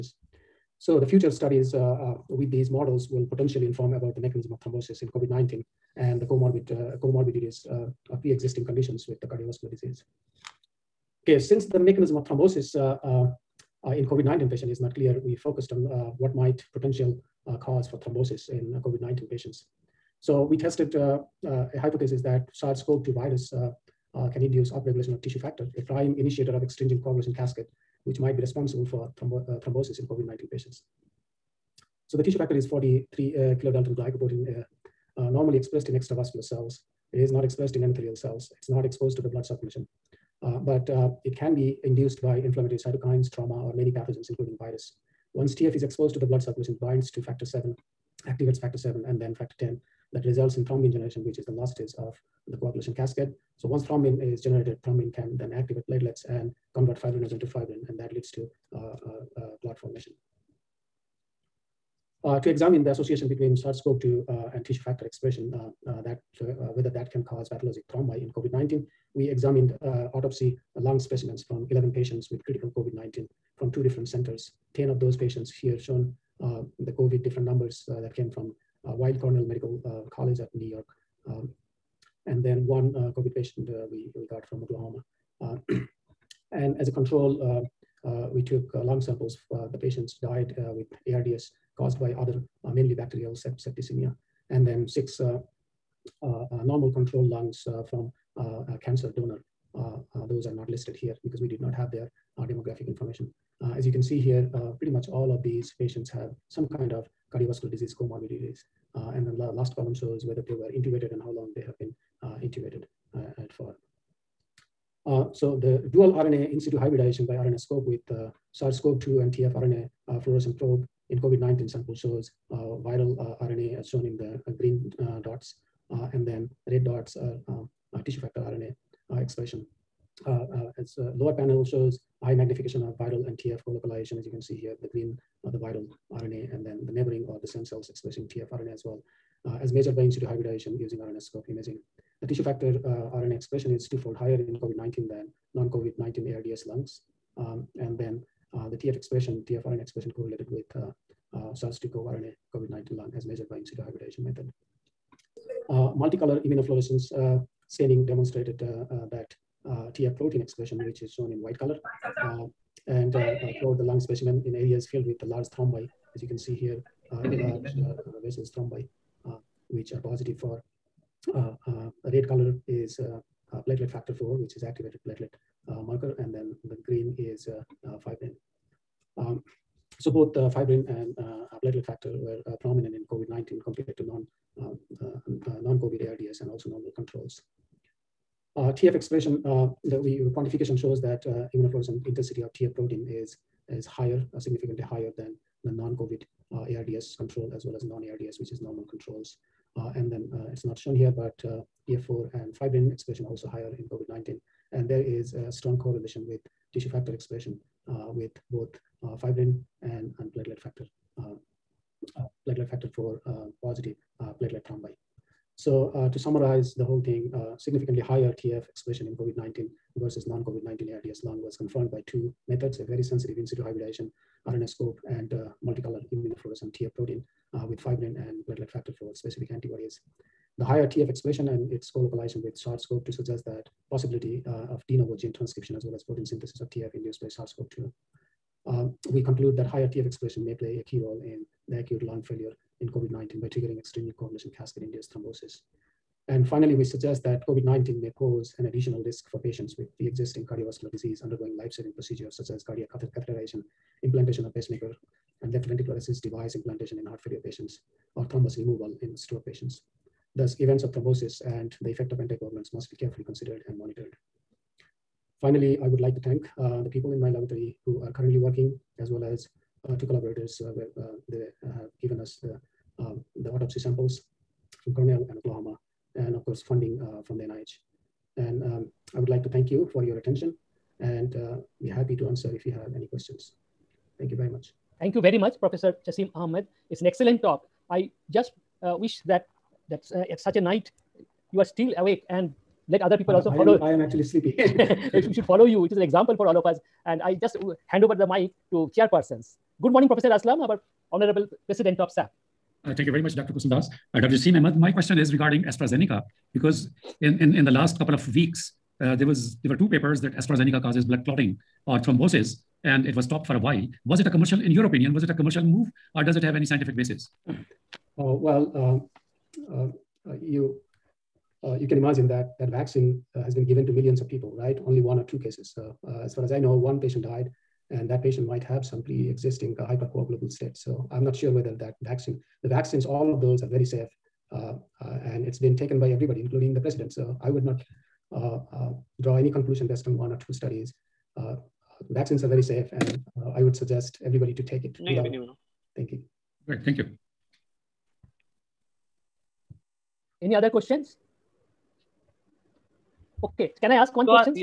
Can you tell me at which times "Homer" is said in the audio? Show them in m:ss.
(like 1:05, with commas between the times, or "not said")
not said.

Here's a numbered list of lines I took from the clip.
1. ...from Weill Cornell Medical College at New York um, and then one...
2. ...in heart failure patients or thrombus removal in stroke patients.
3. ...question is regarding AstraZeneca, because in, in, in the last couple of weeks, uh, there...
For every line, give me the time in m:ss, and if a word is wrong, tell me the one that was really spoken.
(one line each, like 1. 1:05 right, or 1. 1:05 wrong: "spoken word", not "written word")
1. 1:18 right
2. 4:16 right
3. 5:04 right.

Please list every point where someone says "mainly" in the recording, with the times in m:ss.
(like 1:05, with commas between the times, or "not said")
1:32.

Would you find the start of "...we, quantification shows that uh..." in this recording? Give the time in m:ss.
3:10.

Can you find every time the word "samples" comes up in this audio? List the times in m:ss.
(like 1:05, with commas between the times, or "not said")
1:29, 2:01, 4:33.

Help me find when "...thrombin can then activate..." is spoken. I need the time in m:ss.
0:54.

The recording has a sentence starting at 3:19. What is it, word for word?
and then it's not shown here, but PF4 and fibrin expression also higher in COVID-19.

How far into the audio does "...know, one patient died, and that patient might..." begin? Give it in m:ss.
5:26.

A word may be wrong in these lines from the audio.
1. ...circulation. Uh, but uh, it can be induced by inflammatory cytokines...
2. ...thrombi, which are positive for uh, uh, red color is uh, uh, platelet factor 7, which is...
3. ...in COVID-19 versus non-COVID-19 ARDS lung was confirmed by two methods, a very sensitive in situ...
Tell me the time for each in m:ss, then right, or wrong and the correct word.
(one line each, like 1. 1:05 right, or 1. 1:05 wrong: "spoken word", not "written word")
1. 0:39 right
2. 2:48 wrong: "4", not "7"
3. 3:39 right.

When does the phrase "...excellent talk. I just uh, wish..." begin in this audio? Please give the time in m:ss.
4:47.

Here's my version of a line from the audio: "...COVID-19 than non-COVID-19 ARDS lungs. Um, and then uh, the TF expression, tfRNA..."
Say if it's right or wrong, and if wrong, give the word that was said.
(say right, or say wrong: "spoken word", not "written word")
right.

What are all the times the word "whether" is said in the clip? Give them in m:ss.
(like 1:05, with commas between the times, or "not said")
1:06, 1:50, 5:31.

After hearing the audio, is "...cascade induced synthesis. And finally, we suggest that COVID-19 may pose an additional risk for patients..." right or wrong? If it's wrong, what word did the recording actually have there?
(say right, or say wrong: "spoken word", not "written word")
wrong: "thrombosis", not "synthesis".